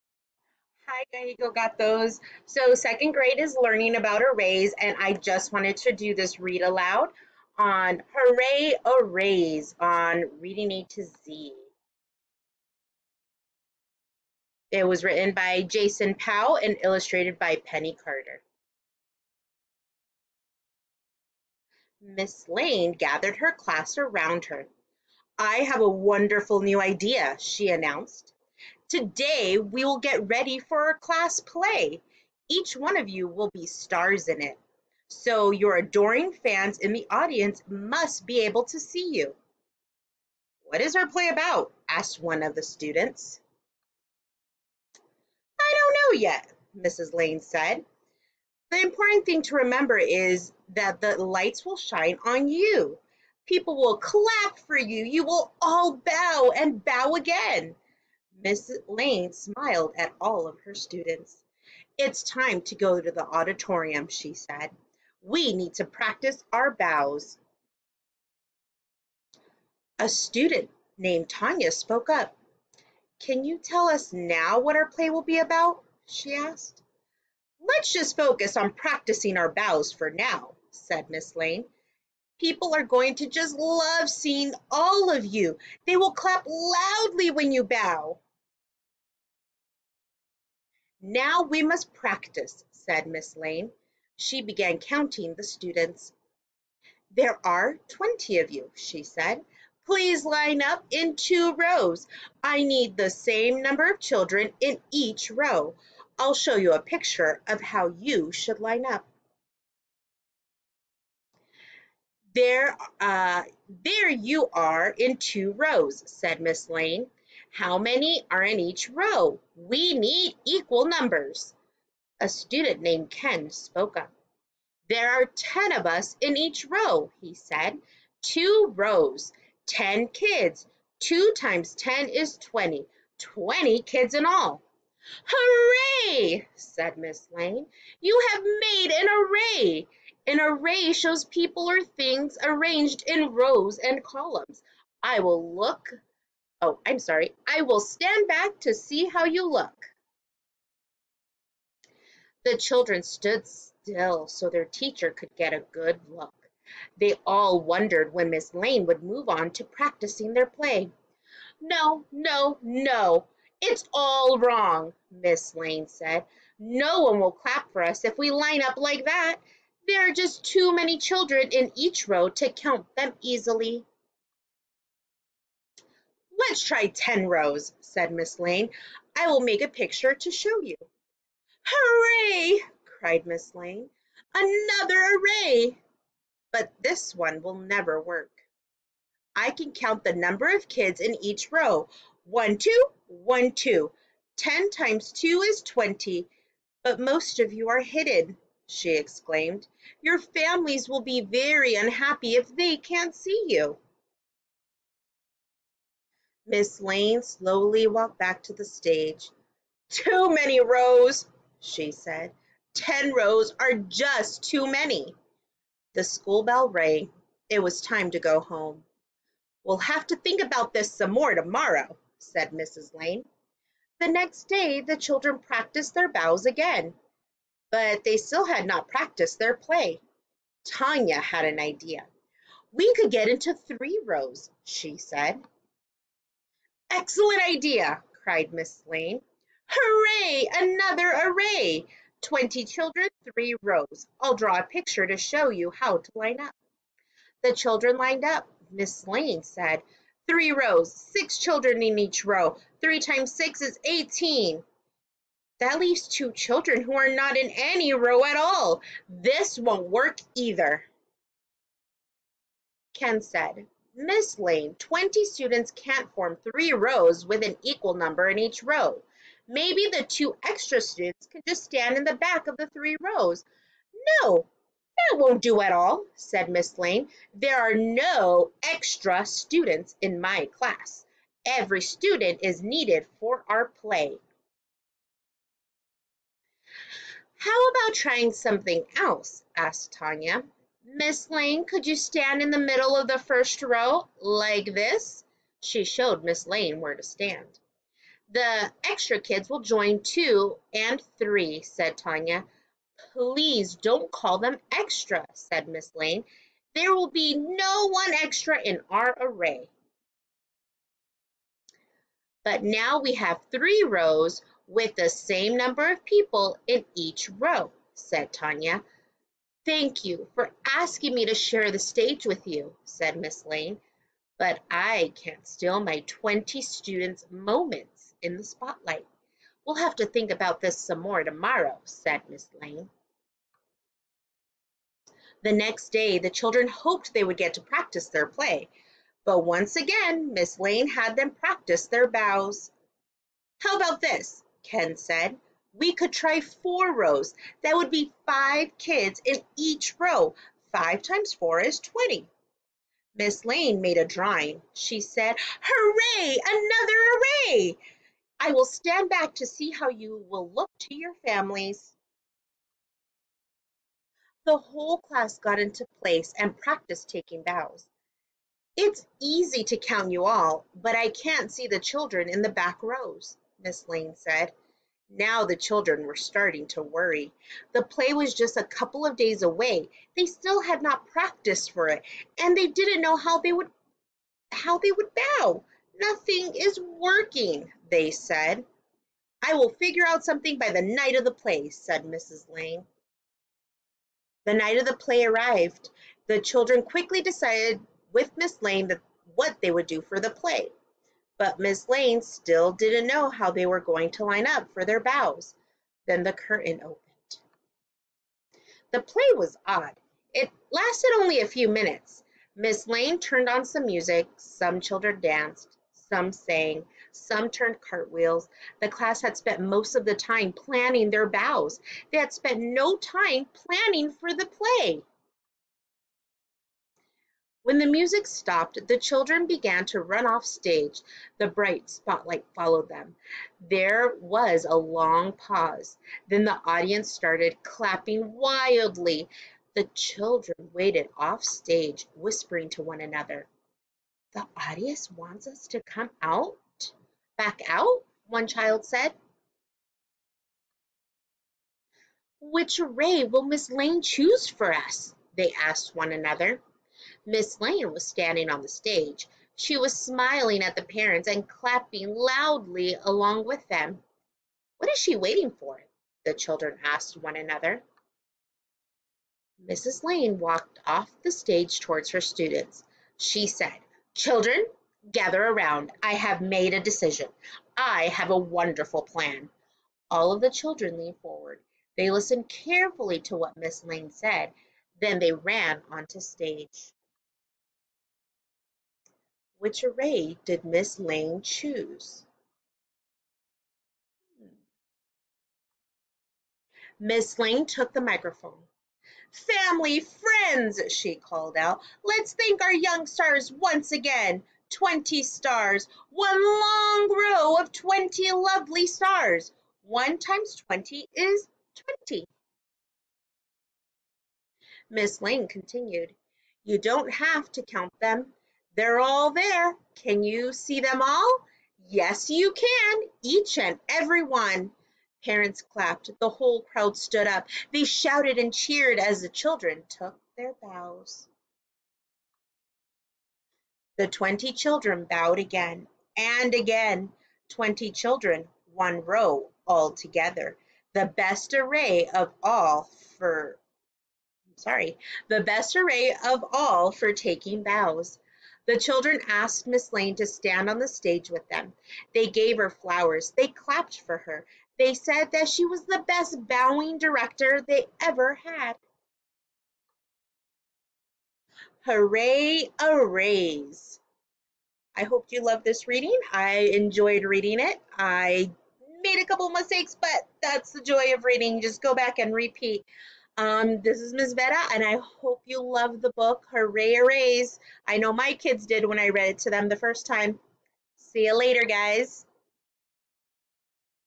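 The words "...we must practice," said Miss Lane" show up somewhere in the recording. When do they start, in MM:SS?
01:31.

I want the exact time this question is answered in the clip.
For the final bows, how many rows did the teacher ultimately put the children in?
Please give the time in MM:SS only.
08:26.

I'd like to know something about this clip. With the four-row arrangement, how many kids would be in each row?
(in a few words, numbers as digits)
5.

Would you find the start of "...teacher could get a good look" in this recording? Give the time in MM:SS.
02:34.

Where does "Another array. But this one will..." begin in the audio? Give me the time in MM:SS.
03:04.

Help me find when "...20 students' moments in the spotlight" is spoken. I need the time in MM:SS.
05:25.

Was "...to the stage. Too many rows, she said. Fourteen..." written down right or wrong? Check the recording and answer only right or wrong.
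wrong.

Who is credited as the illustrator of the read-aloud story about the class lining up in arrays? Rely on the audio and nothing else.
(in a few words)
Penny Carter.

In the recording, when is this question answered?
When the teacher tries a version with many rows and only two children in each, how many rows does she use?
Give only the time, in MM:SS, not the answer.
02:56.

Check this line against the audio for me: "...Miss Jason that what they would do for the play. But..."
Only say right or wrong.
wrong.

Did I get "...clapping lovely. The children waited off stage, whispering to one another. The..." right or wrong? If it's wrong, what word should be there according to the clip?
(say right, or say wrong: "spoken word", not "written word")
wrong: "wildly", not "lovely".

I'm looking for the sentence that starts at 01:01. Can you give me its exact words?
It's time to go to the auditorium, she said.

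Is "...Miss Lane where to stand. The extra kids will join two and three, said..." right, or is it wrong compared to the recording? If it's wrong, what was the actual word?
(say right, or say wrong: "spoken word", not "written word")
right.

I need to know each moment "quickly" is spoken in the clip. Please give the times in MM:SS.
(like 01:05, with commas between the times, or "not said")
06:36.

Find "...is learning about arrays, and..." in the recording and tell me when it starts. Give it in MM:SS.
00:03.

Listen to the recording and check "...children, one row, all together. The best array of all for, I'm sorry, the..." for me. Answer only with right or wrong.
right.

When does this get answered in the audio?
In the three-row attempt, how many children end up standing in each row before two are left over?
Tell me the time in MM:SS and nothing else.
04:10.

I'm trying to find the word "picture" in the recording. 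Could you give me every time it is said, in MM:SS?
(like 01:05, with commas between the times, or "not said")
01:46, 02:59, 04:04.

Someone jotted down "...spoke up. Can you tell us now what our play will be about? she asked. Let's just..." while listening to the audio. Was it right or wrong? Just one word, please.
right.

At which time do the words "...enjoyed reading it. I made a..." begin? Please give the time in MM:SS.
09:26.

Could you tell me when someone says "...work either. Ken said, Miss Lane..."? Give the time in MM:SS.
04:19.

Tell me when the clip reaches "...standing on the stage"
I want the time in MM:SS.
07:38.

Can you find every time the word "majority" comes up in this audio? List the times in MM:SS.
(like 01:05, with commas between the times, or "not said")
not said.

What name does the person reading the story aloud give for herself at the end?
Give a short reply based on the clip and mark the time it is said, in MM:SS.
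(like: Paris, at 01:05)
Ms. Vera, at 09:34.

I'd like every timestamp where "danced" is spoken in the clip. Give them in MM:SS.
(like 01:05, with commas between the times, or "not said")
06:55.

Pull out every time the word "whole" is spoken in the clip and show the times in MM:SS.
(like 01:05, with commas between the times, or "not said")
06:04, 08:46.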